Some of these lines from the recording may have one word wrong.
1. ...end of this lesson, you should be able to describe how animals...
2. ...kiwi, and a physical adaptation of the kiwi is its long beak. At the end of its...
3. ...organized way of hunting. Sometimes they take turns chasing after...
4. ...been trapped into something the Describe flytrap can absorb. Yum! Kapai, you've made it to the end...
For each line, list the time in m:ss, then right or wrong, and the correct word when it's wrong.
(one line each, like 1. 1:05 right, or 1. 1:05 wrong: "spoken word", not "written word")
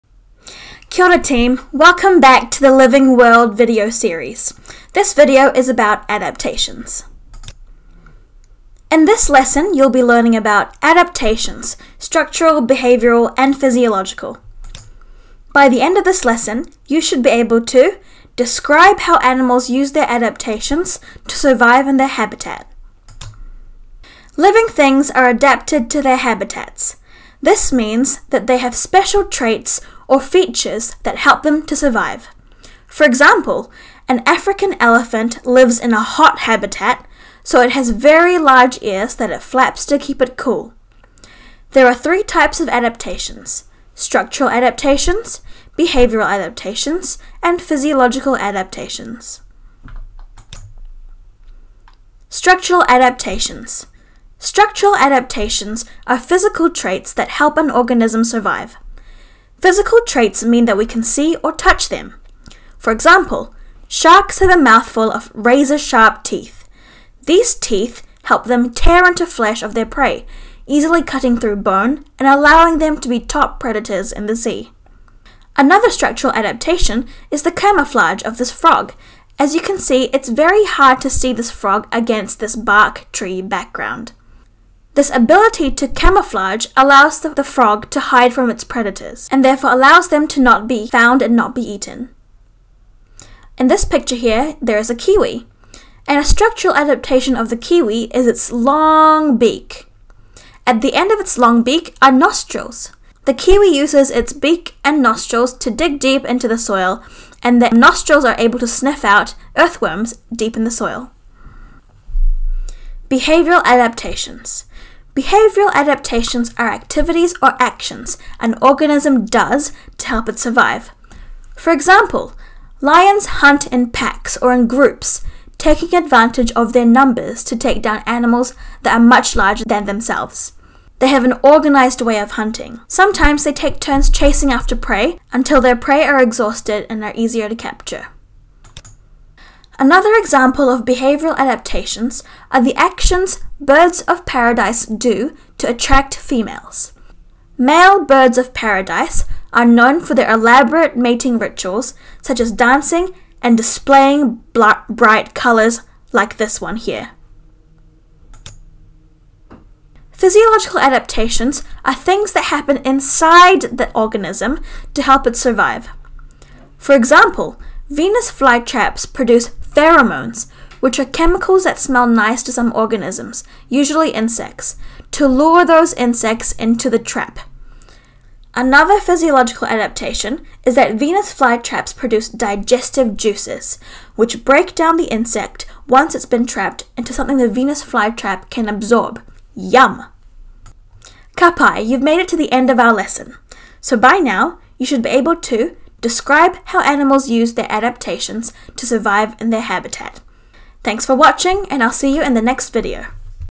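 1. 0:15 right
2. 1:34 wrong: "structural", not "physical"
3. 2:11 right
4. 3:06 wrong: "Venus", not "Describe".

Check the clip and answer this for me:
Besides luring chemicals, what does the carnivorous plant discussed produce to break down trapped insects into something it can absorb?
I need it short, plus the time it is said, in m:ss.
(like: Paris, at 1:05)
Digestive juices, at 3:02.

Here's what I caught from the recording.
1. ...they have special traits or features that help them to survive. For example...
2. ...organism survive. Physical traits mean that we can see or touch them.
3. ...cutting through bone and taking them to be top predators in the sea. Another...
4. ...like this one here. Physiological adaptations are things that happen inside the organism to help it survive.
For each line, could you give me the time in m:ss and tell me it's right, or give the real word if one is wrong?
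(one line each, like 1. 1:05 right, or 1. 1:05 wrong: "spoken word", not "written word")
1. 0:28 right
2. 0:57 right
3. 1:11 wrong: "allowing", not "taking"
4. 2:36 right.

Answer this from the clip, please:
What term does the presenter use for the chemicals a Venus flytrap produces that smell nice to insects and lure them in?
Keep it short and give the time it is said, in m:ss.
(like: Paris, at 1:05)
Pheromones, at 2:49.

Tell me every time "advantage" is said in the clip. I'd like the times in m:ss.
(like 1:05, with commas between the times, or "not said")
2:05.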